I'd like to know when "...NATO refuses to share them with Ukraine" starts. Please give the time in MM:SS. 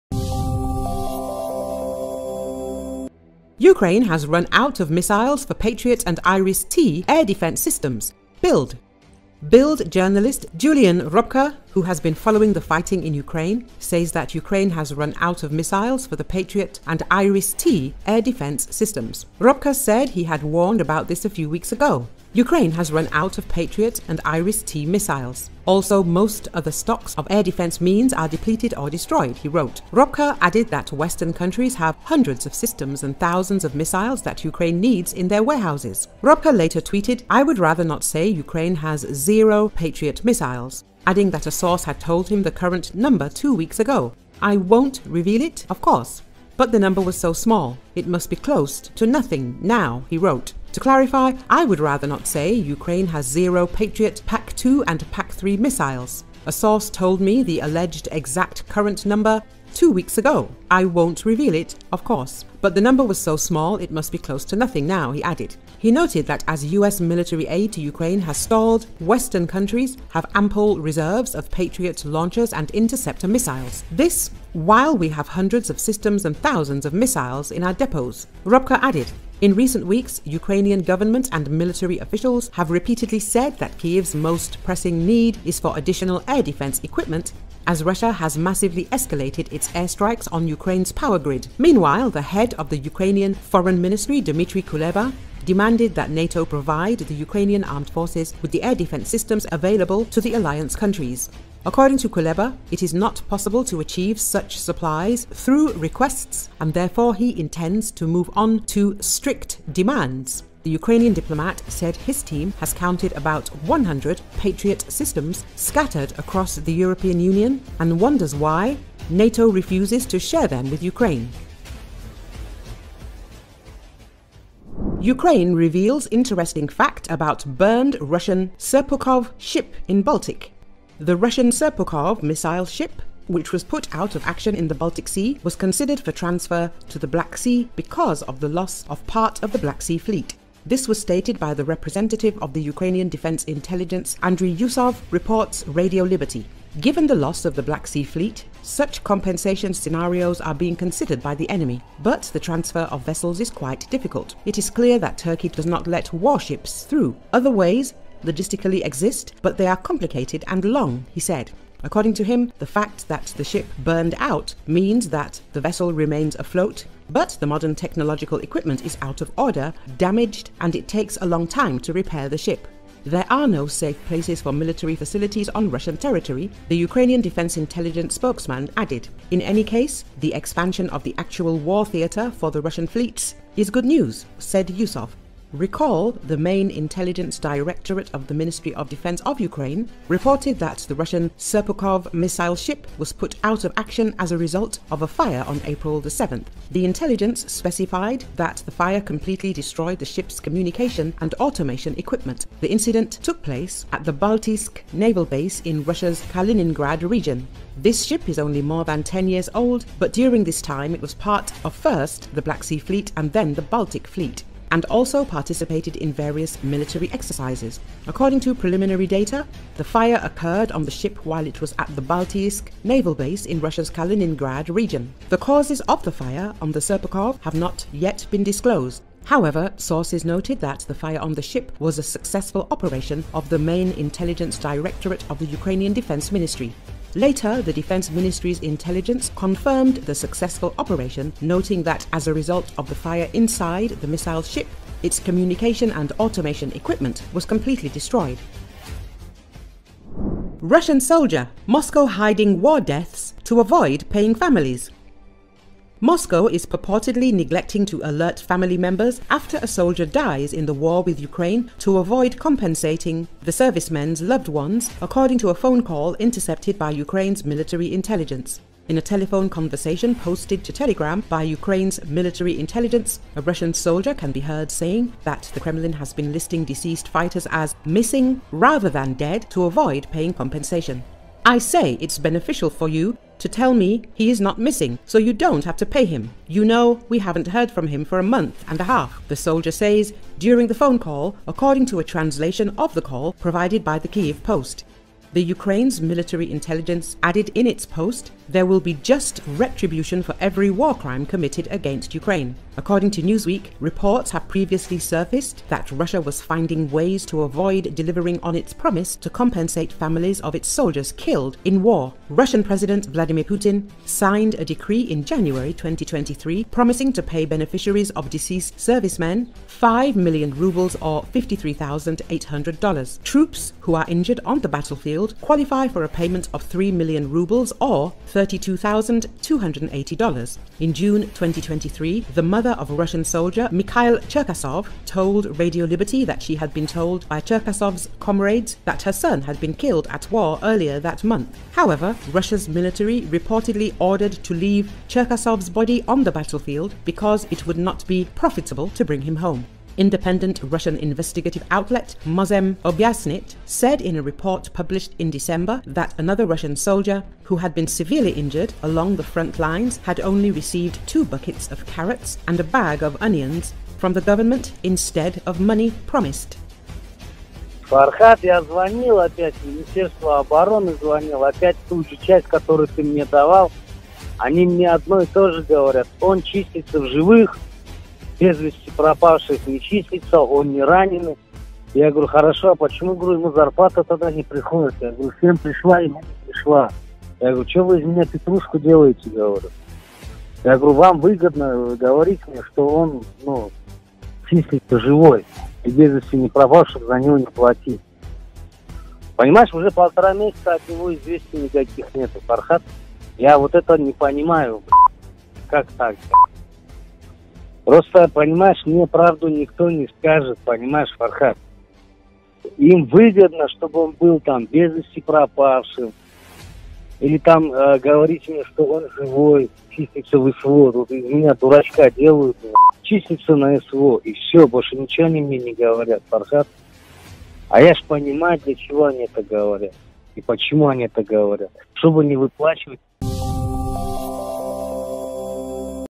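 01:59.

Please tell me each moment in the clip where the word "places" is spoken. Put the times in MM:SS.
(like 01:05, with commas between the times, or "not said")
02:54, 03:23.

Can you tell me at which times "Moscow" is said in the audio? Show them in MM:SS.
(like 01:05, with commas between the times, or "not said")
04:11, 04:16.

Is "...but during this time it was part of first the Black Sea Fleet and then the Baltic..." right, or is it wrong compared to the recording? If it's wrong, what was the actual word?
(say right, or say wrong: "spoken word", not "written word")
right.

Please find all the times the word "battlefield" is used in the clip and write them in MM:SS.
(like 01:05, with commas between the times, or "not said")
05:24, 05:46.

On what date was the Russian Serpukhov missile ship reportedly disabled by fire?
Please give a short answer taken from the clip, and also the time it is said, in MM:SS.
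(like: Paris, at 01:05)
April 7, at 03:15.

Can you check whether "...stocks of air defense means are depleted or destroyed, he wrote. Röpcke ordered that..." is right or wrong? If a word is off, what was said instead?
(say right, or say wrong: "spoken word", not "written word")
wrong: "added", not "ordered".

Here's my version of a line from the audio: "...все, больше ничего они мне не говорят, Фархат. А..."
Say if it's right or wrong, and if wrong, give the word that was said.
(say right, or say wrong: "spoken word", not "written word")
right.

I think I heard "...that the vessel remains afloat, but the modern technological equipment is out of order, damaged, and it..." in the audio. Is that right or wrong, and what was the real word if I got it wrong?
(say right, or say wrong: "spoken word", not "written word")
right.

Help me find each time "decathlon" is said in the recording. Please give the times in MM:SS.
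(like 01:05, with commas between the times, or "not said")
not said.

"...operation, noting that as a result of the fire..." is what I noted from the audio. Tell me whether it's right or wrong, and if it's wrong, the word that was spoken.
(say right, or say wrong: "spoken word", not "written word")
right.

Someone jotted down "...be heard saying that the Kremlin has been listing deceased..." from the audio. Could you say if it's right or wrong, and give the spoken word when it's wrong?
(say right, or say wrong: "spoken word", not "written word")
right.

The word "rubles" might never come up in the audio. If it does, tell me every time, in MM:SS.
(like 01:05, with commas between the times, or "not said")
05:20, 05:27.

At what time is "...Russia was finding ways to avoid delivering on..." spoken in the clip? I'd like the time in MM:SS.
05:05.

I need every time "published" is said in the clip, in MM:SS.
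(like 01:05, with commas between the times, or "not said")
05:54.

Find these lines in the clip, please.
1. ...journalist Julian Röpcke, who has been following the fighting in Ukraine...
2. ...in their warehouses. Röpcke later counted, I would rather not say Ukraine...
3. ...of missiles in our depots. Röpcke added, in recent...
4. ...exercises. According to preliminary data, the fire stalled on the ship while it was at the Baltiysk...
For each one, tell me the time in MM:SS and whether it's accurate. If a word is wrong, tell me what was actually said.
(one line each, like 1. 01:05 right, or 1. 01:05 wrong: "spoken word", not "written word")
1. 00:09 right
2. 00:35 wrong: "tweeted", not "counted"
3. 01:16 right
4. 03:37 wrong: "occurred", not "stalled".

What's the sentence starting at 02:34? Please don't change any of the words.
It is clear that Turkey does not let warships through.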